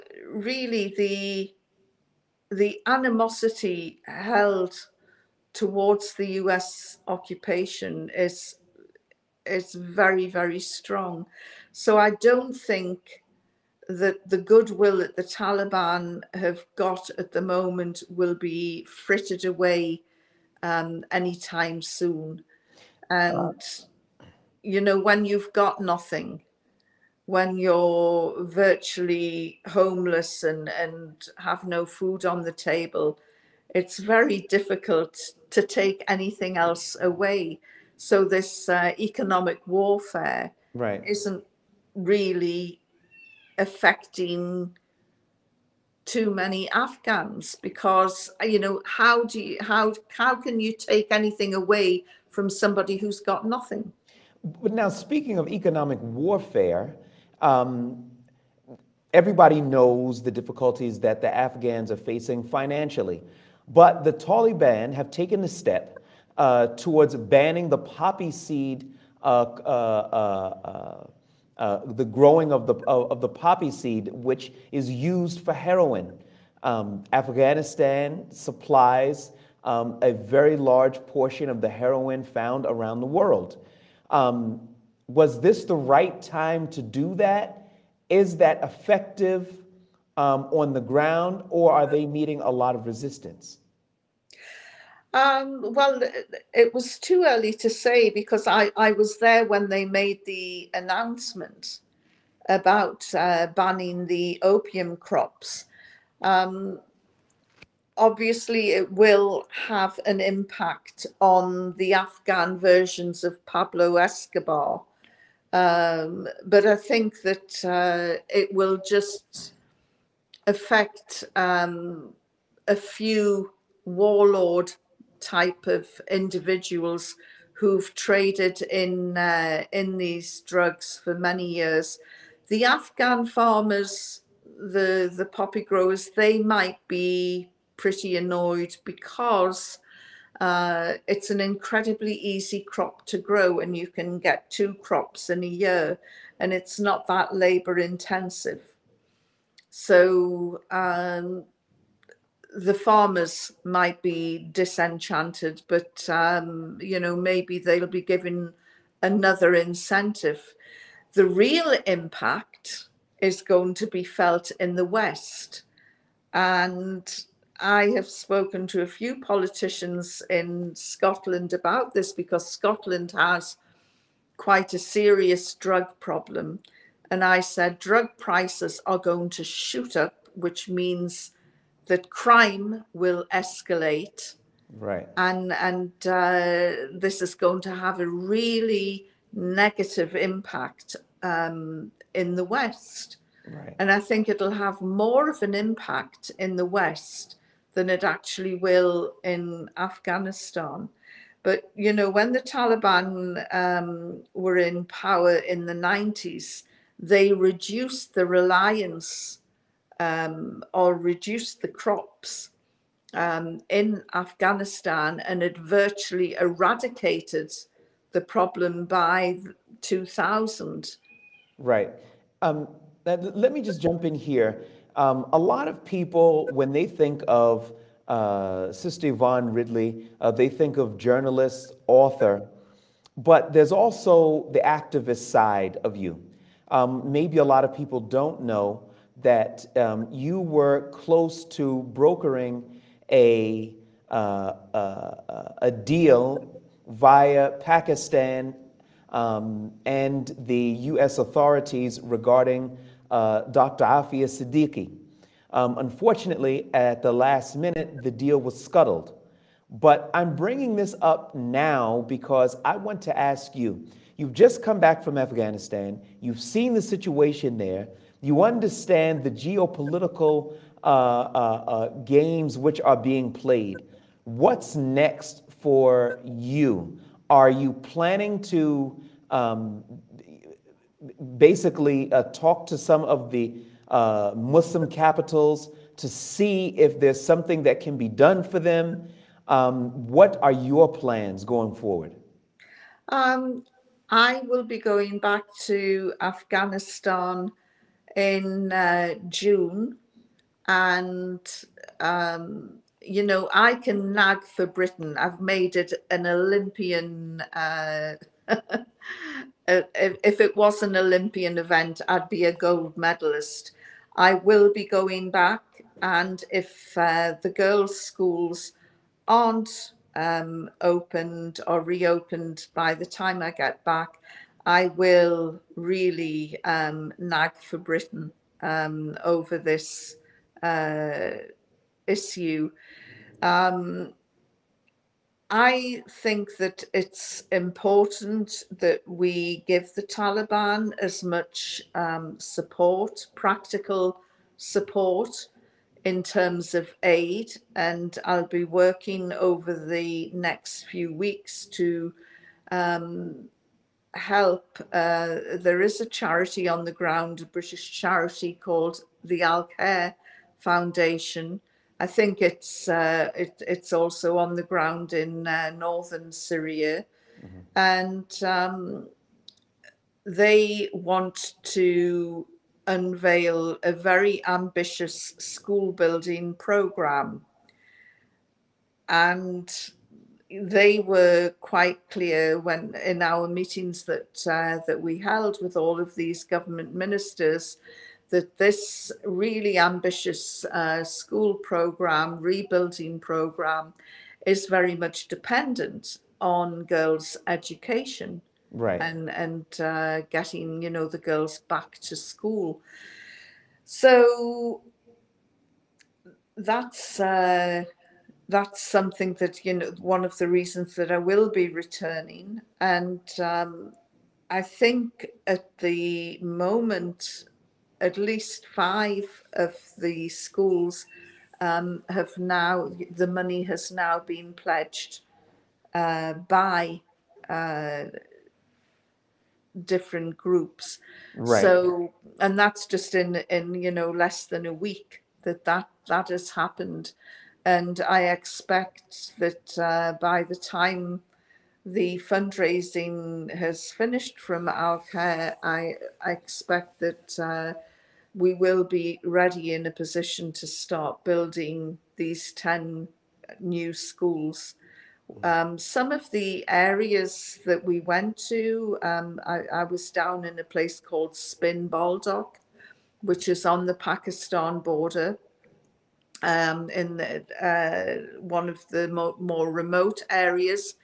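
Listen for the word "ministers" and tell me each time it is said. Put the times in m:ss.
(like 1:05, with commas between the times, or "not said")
6:26.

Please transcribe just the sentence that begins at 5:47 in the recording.
And I'll be working over the next few weeks to um, help.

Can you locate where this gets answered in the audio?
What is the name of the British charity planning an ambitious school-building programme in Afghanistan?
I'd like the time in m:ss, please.
5:59.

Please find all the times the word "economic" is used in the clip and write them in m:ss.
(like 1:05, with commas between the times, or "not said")
0:38, 0:55.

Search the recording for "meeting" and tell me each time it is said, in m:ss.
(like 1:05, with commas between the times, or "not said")
1:32, 6:23.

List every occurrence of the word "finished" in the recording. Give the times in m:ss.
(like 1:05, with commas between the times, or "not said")
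7:23.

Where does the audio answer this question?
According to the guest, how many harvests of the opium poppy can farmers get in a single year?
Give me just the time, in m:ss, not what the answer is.
2:24.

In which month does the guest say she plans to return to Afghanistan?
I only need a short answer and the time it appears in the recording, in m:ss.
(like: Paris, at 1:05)
June, at 4:59.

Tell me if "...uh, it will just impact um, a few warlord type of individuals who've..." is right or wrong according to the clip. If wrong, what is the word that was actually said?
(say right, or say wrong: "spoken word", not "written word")
wrong: "affect", not "impact".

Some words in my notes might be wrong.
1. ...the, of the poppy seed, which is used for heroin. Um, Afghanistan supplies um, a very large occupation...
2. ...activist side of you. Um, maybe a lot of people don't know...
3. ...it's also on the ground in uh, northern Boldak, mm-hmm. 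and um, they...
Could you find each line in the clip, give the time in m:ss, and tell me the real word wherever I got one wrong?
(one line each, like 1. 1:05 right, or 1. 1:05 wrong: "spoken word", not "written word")
1. 1:12 wrong: "portion", not "occupation"
2. 3:54 right
3. 6:03 wrong: "Syria", not "Boldak".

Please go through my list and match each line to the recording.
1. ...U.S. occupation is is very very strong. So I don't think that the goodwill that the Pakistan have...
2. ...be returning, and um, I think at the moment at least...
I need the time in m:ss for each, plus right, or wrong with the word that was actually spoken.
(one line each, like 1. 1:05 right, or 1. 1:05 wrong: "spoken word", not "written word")
1. 0:06 wrong: "Taliban", not "Pakistan"
2. 6:51 right.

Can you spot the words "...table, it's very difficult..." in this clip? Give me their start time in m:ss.
0:32.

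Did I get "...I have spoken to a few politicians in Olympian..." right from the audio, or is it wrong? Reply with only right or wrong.
wrong.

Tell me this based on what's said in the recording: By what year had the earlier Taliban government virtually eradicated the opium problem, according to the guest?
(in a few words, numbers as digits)
2000.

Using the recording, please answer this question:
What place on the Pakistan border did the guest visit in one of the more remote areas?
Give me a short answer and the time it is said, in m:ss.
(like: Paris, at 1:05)
Spin Boldak, at 7:41.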